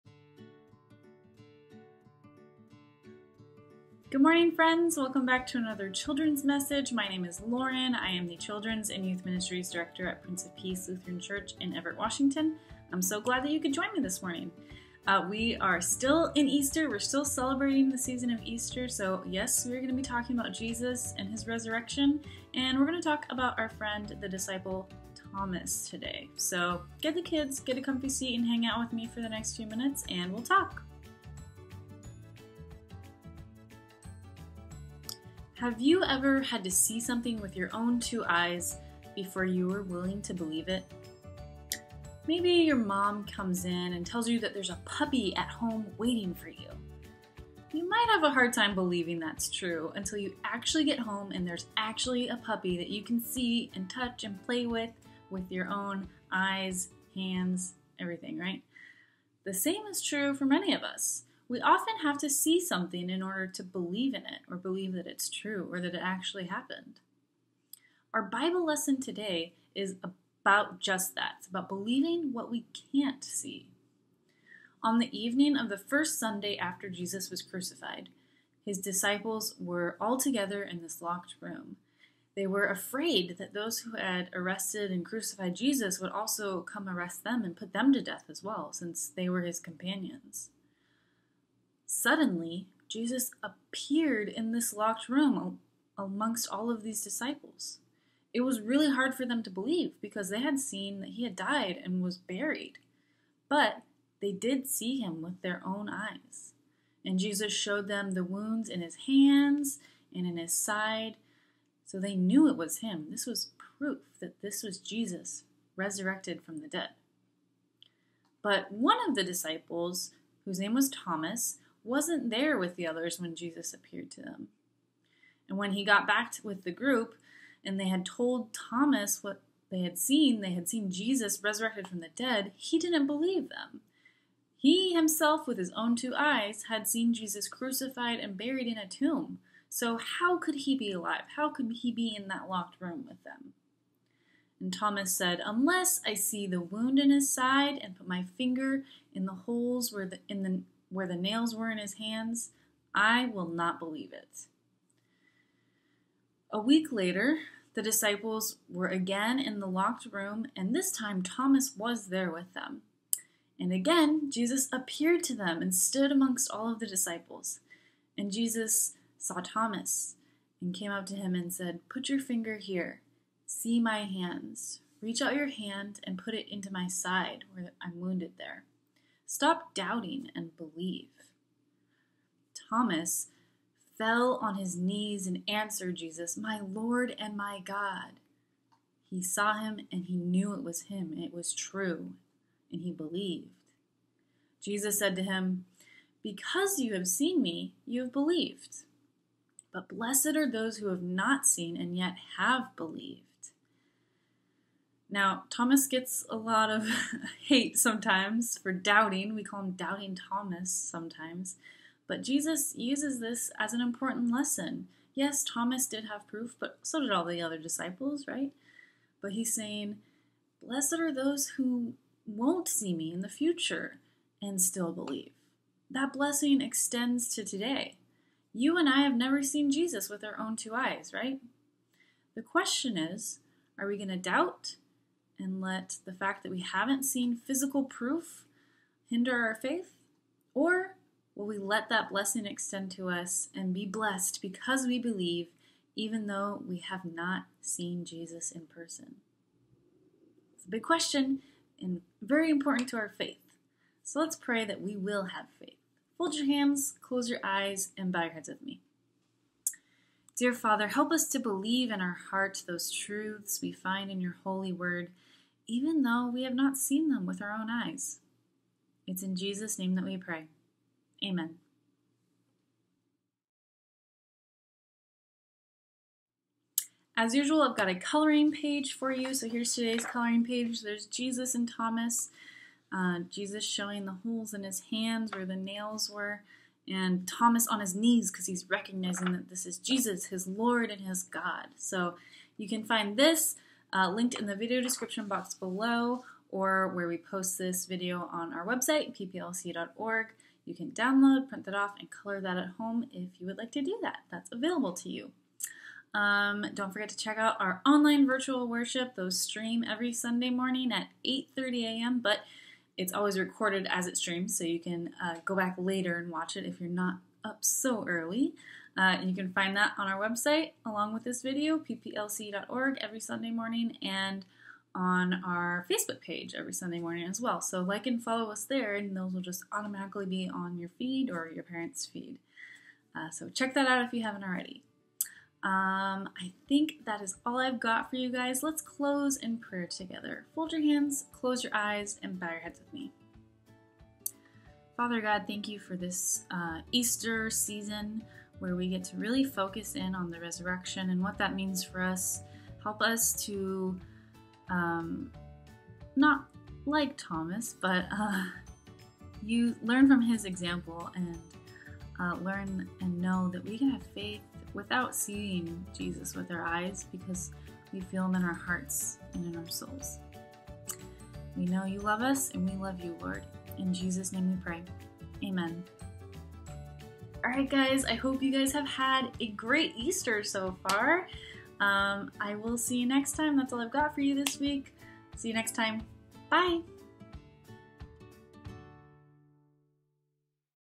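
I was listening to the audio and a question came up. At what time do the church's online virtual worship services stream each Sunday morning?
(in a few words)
8:30 a.m.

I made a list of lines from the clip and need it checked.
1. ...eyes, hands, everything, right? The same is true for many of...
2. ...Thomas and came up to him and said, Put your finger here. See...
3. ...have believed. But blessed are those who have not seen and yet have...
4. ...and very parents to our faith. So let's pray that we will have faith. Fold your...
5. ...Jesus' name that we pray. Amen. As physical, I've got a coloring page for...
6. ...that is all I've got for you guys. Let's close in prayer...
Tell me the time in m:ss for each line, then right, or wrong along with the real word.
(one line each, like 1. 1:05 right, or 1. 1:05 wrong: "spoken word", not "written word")
1. 0:56 right
2. 2:49 right
3. 3:18 right
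4. 4:11 wrong: "important", not "parents"
5. 4:29 wrong: "usual", not "physical"
6. 5:37 right.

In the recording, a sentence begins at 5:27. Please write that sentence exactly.
So like and follow us there, and those will just automatically be on your feed or your parents' feed.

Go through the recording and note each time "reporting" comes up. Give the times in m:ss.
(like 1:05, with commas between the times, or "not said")
not said.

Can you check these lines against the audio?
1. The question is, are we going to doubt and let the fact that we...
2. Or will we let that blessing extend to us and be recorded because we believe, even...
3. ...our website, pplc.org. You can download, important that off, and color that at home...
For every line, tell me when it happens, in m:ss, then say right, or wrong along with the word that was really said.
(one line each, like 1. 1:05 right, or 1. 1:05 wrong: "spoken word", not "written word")
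1. 3:52 right
2. 4:00 wrong: "blessed", not "recorded"
3. 4:58 wrong: "print", not "important".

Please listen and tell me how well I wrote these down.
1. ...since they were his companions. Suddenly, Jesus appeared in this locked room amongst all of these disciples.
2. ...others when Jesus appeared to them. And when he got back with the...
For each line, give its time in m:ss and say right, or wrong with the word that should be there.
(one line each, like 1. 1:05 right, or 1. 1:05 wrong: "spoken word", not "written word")
1. 1:28 right
2. 2:02 right.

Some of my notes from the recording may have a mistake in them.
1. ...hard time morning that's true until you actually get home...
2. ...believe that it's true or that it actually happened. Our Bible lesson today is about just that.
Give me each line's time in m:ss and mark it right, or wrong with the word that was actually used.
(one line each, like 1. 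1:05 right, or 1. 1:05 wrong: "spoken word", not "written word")
1. 0:48 wrong: "believing", not "morning"
2. 1:04 right.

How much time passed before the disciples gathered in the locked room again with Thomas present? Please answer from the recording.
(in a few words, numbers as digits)
A week.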